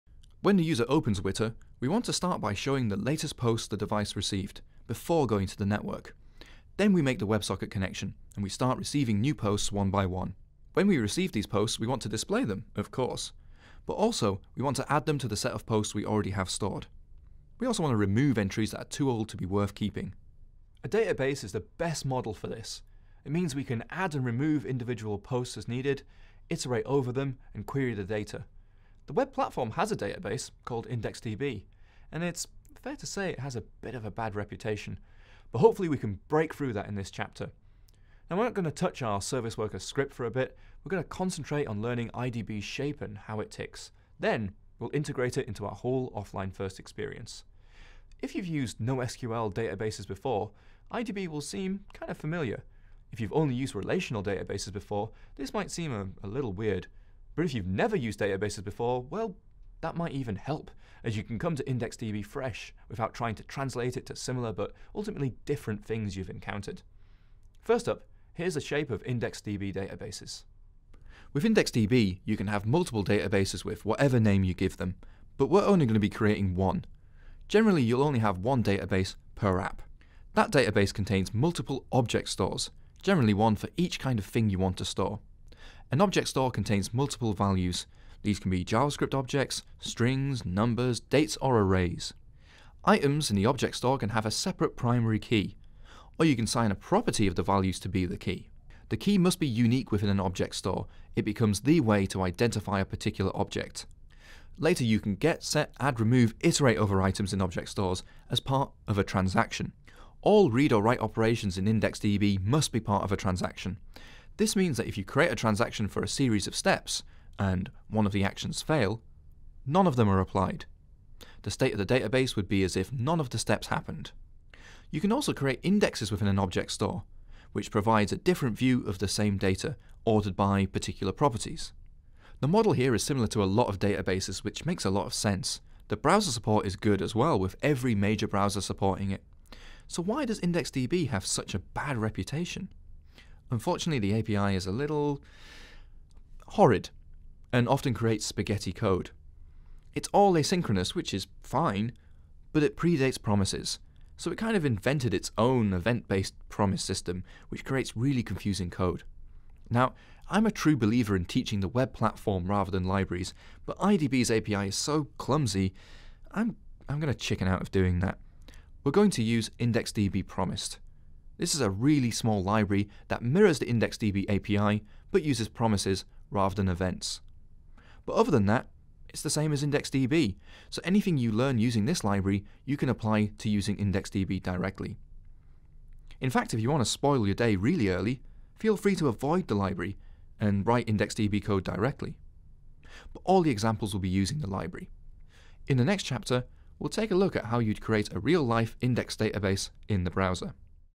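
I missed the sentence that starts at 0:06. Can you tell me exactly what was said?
Then we make the WebSocket connection, and we start receiving new posts one by one.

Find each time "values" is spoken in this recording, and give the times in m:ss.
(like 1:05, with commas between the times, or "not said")
1:27, 1:37.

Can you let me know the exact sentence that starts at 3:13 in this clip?
But all the examples will be using the library.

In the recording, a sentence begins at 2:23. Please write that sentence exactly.
Unfortunately, the API is a little horrid and often creates spaghetti code.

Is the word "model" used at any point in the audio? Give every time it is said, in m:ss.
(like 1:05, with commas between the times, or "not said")
0:22, 2:12.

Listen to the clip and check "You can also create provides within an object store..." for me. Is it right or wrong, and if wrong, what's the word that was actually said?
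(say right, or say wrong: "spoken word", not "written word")
wrong: "indexes", not "provides".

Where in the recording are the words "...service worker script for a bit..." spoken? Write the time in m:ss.
0:39.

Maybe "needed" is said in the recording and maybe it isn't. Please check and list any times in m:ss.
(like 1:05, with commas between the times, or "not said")
0:25.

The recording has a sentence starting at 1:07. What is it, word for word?
First up, here's the shape of IndexedDB databases.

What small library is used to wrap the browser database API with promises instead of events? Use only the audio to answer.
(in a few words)
IndexedDB promised.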